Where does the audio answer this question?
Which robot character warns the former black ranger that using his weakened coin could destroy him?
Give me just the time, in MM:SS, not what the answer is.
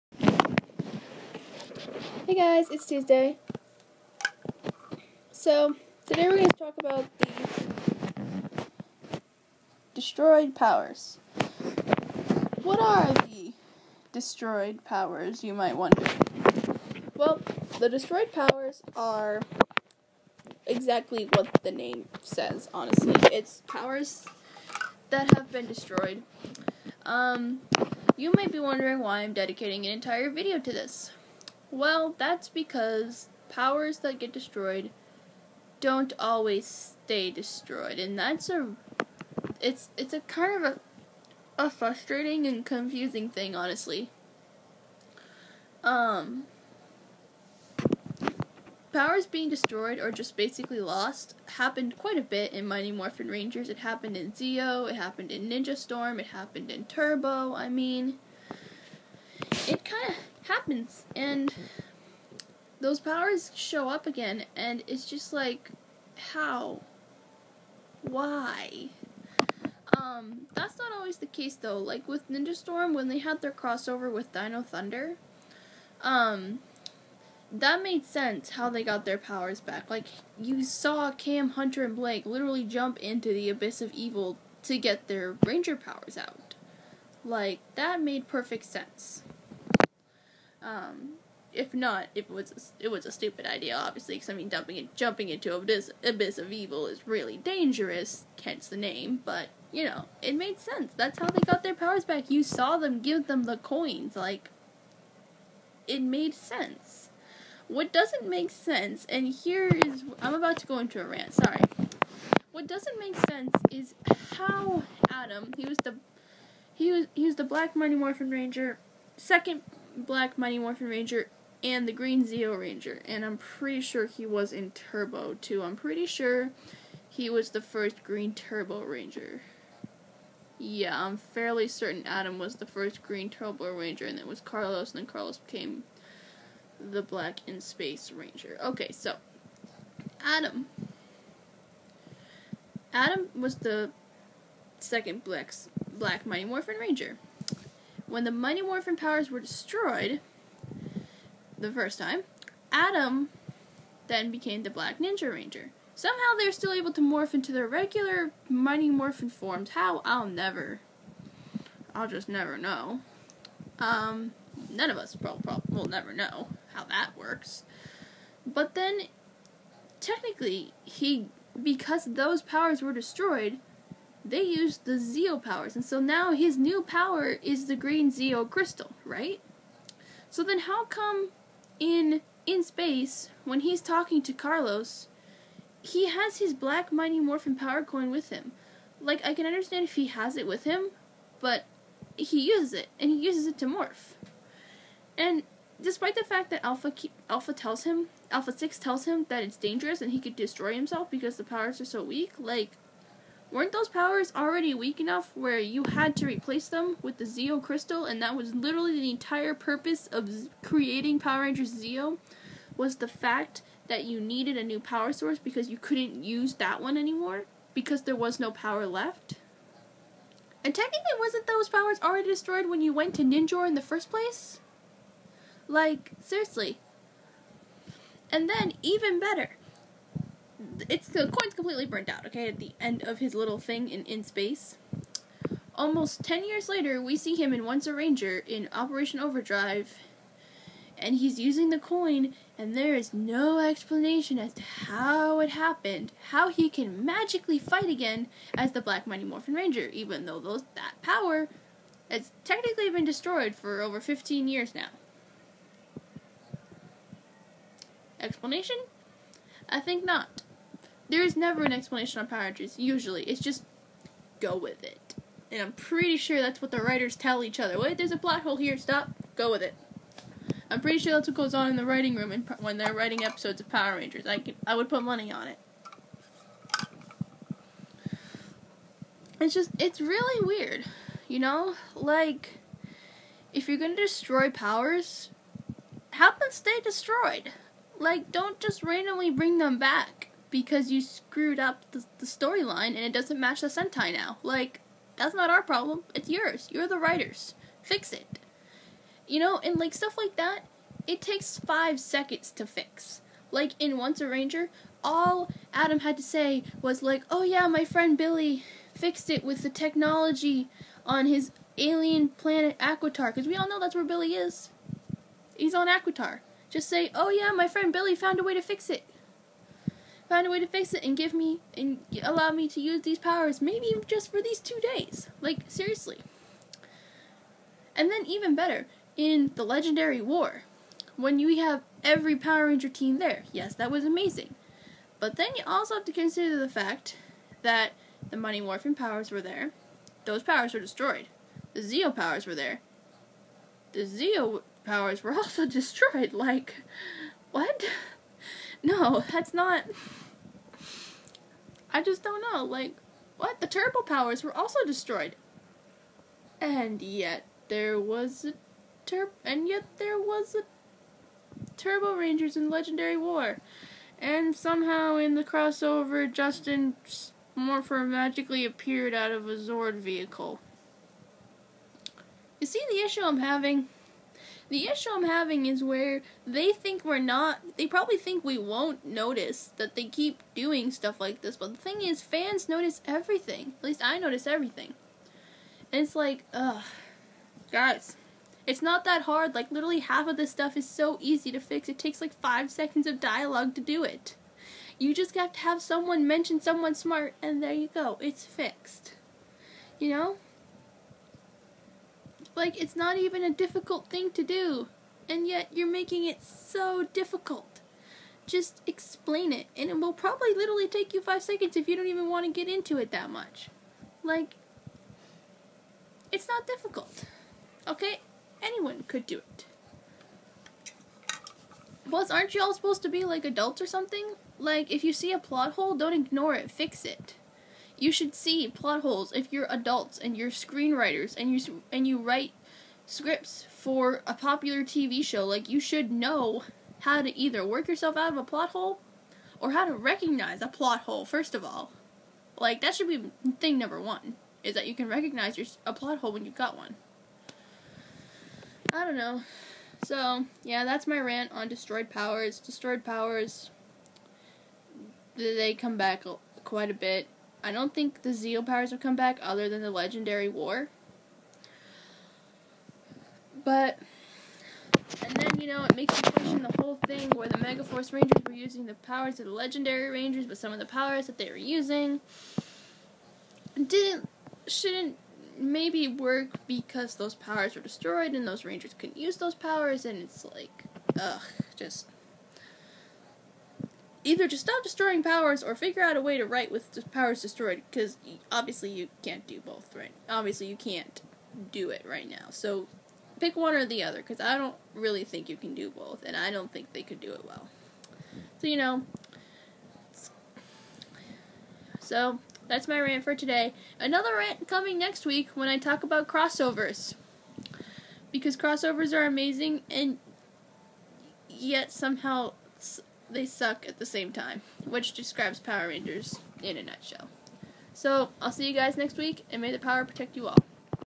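03:18.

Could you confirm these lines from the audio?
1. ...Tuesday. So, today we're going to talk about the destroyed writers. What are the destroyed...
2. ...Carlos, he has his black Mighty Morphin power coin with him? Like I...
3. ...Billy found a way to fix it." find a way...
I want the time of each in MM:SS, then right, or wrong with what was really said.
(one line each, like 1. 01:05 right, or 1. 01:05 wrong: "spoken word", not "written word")
1. 00:02 wrong: "powers", not "writers"
2. 03:04 right
3. 05:17 right.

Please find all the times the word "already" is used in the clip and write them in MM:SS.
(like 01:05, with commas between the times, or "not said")
03:24, 03:42.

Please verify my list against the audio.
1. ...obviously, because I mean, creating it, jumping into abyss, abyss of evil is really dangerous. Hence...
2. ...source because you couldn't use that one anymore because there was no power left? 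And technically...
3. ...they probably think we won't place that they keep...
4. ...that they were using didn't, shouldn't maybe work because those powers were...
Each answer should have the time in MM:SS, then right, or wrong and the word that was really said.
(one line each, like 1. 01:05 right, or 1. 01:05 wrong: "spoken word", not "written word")
1. 01:33 wrong: "dumping", not "creating"
2. 03:35 right
3. 06:17 wrong: "notice", not "place"
4. 07:51 right.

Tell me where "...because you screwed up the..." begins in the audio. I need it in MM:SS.
04:50.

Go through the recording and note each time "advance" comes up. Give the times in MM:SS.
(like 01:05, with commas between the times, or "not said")
not said.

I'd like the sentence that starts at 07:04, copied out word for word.
Like, if you see a plot hole, don't ignore it, fix it.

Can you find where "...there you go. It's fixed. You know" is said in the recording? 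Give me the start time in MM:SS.
06:37.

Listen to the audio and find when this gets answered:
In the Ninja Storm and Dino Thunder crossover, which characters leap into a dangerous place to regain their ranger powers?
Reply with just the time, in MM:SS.
01:21.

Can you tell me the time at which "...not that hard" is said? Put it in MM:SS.
06:28.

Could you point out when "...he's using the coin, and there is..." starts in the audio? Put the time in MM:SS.
04:01.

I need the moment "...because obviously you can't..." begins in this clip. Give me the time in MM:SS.
08:07.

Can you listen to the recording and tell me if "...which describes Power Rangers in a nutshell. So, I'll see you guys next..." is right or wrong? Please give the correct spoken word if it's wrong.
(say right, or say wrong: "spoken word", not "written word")
right.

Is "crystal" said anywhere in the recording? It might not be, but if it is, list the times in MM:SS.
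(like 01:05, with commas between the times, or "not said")
02:58, 03:27.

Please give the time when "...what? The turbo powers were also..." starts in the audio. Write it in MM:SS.
05:53.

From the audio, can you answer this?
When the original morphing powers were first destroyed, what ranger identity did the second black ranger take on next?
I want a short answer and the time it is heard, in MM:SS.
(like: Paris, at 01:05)
Black Ninja Ranger, at 02:34.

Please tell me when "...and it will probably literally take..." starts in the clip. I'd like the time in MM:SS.
06:49.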